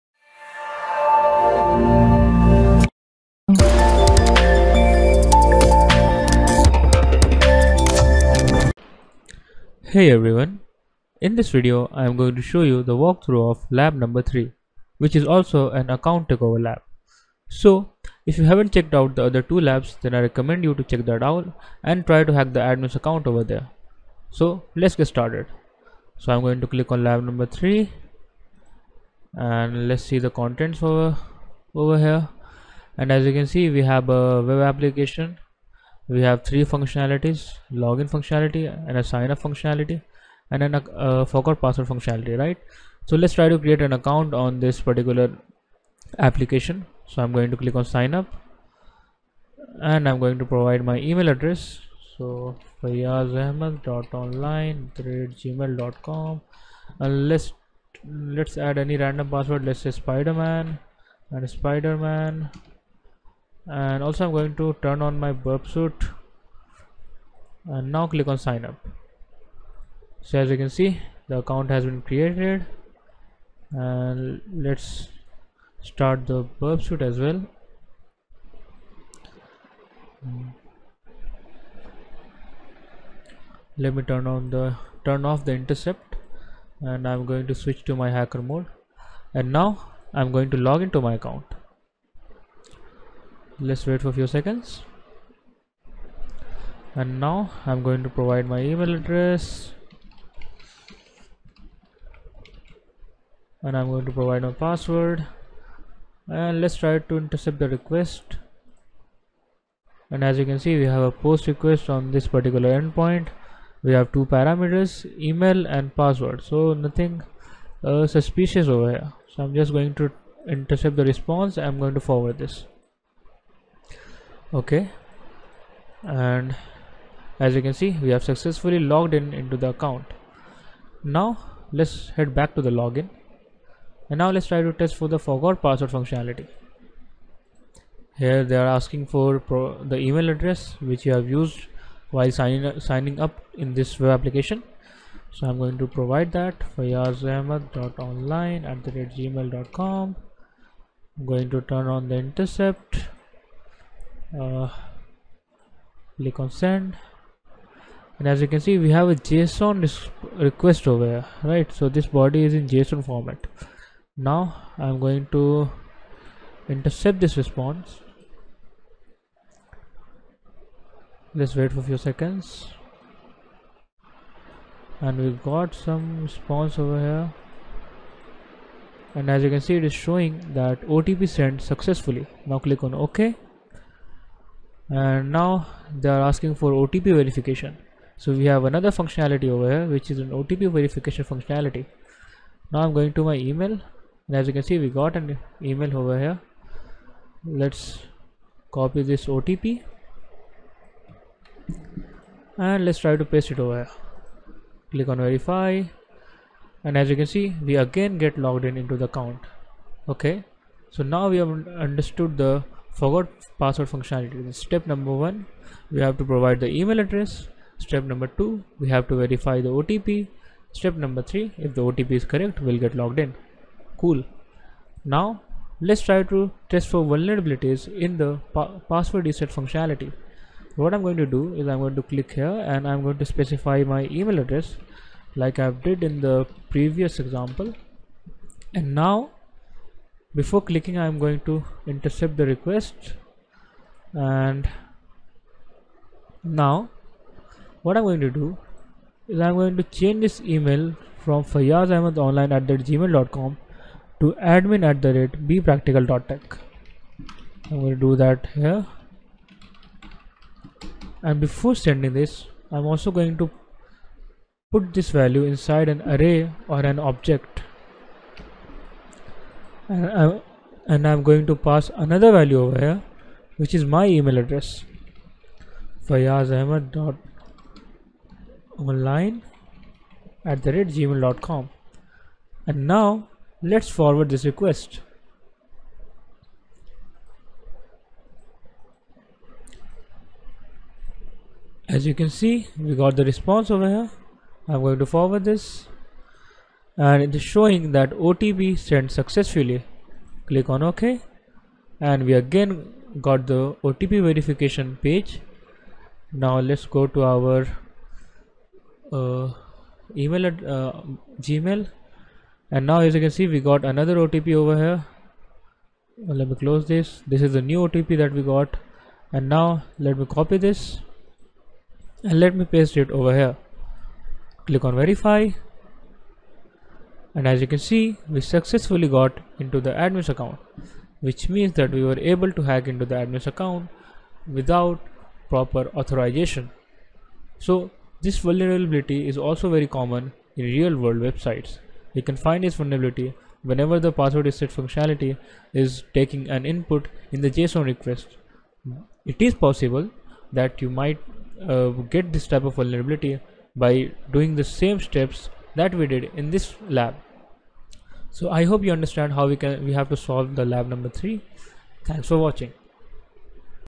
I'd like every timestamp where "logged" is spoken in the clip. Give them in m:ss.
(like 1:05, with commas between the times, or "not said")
2:08, 3:28, 3:42.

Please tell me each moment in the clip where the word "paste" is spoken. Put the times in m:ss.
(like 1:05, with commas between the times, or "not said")
3:23, 5:22.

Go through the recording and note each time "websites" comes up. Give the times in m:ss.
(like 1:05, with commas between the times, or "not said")
5:41.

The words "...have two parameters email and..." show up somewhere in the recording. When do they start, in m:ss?
1:53.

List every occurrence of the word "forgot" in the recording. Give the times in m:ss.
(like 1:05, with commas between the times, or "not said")
0:41, 2:15, 3:32.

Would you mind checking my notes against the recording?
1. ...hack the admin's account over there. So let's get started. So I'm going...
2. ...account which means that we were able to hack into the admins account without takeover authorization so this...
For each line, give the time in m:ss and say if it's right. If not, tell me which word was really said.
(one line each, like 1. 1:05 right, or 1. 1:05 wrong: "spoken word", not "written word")
1. 0:22 right
2. 5:30 wrong: "proper", not "takeover".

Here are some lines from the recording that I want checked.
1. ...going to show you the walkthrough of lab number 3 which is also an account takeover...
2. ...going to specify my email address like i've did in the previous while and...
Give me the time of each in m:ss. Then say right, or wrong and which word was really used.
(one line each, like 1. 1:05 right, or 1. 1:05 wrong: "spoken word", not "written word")
1. 0:12 right
2. 3:53 wrong: "example", not "while".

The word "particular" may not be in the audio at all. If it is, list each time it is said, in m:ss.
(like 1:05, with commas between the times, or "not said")
0:44, 1:52.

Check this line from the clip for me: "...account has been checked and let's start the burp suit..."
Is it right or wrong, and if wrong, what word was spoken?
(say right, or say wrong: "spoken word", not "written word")
wrong: "created", not "checked".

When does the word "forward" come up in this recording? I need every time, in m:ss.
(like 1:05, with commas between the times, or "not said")
2:01, 4:43, 4:55.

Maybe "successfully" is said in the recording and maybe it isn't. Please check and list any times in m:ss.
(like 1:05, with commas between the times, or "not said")
2:08, 3:01, 4:59, 5:28.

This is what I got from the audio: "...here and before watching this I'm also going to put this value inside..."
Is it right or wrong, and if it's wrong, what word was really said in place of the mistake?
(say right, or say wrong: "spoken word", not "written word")
wrong: "sending", not "watching".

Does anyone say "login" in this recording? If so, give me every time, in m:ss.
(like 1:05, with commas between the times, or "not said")
0:37, 2:12.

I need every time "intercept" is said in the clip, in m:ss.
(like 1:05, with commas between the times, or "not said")
1:25, 1:47, 2:00, 2:32, 2:46, 4:01.